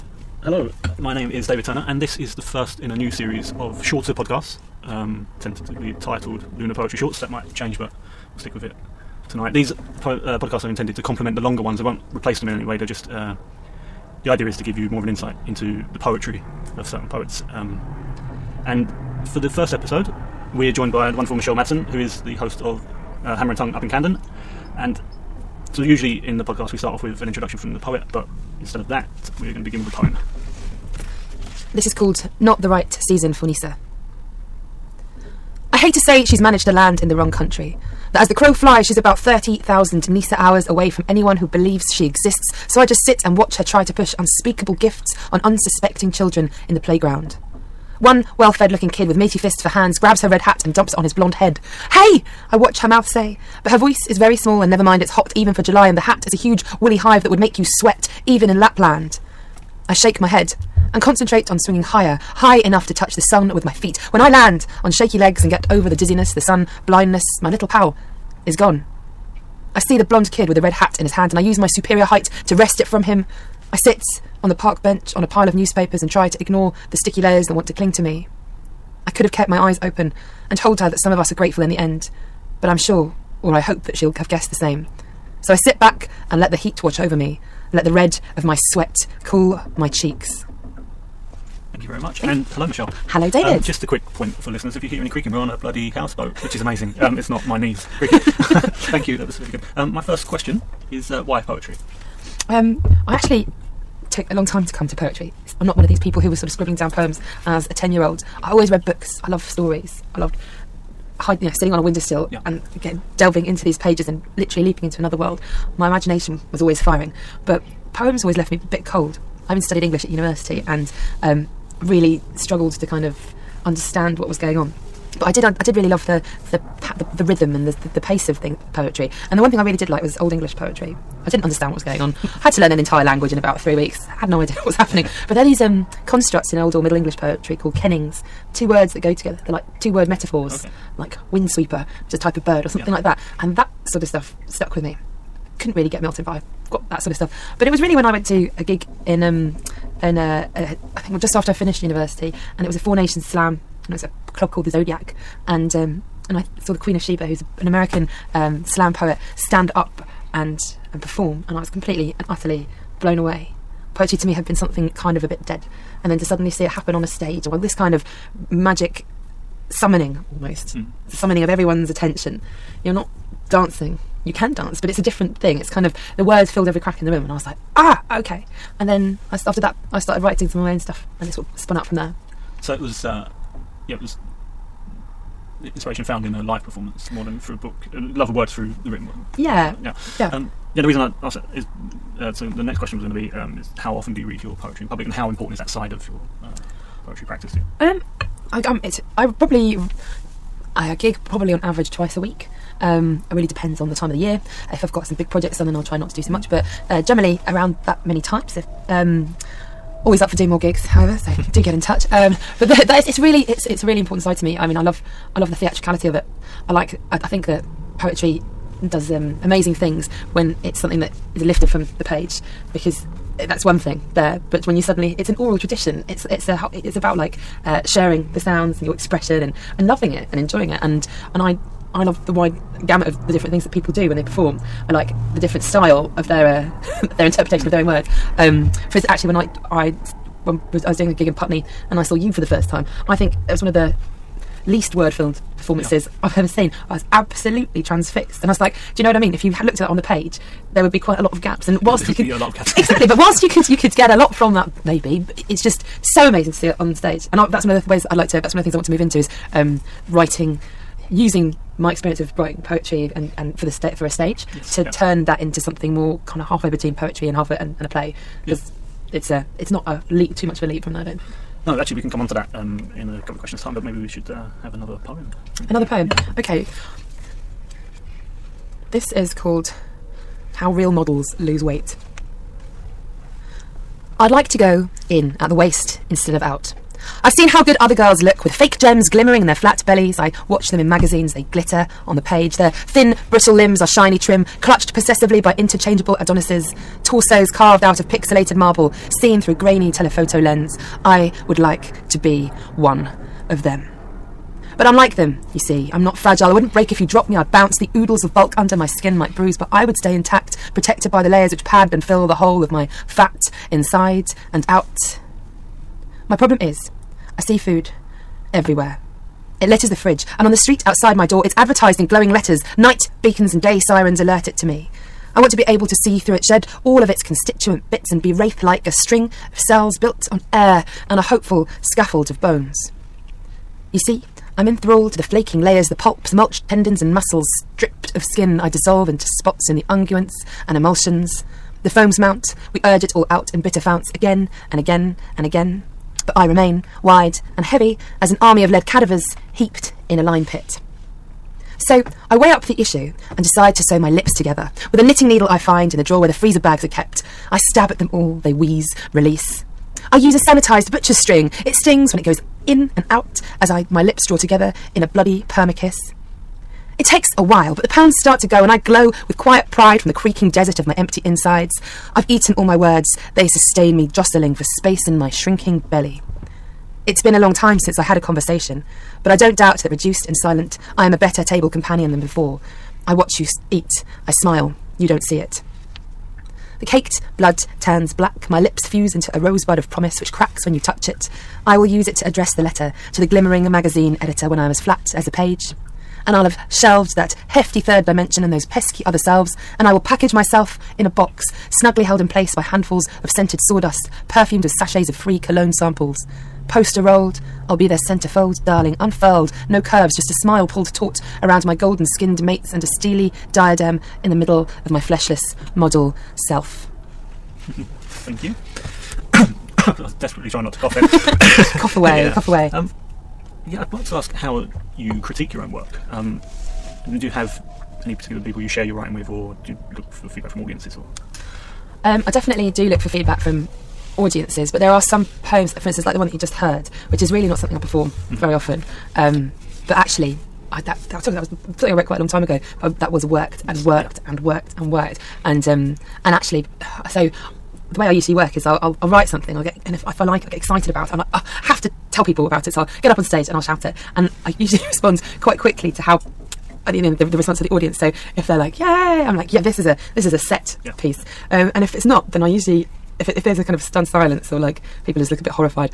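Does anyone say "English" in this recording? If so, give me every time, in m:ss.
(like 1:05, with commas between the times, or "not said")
1:59, 2:10, 2:16.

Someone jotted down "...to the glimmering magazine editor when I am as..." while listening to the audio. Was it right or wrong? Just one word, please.
right.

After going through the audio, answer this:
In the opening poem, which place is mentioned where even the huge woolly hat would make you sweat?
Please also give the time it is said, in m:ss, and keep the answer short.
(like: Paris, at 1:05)
Lapland, at 0:58.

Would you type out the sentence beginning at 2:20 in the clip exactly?
like windsweeper, which is a type of bird, or something yeah.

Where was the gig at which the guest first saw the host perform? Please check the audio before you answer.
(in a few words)
Putney.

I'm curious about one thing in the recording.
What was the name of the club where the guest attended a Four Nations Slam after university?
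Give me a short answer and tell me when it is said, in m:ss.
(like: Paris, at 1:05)
the Zodiac, at 2:34.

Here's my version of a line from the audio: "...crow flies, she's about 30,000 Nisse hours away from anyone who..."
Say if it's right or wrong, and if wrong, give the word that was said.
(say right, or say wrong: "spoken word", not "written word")
right.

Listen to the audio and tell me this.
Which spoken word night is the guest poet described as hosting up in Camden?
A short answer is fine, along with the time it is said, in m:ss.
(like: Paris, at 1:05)
Hammer and Tongue, at 0:23.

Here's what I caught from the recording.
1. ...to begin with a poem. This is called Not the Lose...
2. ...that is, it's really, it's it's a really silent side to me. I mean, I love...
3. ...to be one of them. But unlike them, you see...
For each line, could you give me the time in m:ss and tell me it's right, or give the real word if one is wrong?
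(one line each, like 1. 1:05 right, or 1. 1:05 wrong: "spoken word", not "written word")
1. 0:29 wrong: "Right", not "Lose"
2. 3:32 wrong: "important", not "silent"
3. 5:02 right.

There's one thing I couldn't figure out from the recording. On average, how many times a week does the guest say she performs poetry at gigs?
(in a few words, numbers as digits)
twice.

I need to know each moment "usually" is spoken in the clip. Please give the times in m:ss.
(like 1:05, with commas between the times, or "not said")
0:25, 7:28, 7:34, 7:42.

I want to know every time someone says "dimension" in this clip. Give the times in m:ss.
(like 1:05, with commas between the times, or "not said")
6:38.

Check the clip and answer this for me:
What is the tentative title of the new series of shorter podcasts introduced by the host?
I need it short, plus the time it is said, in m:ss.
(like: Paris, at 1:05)
Lunar Poetry Shorts, at 0:06.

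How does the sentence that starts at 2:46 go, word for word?
And then to suddenly see it happen on a stage, or this kind of magic summoning almost, mm.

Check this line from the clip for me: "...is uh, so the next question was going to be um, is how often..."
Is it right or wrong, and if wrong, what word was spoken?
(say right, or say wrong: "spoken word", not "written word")
right.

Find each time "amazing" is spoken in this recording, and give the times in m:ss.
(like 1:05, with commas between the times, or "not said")
1:36, 3:39, 4:16.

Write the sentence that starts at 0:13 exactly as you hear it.
Uh, the idea is to give you more of an insight into the poetry of certain poets.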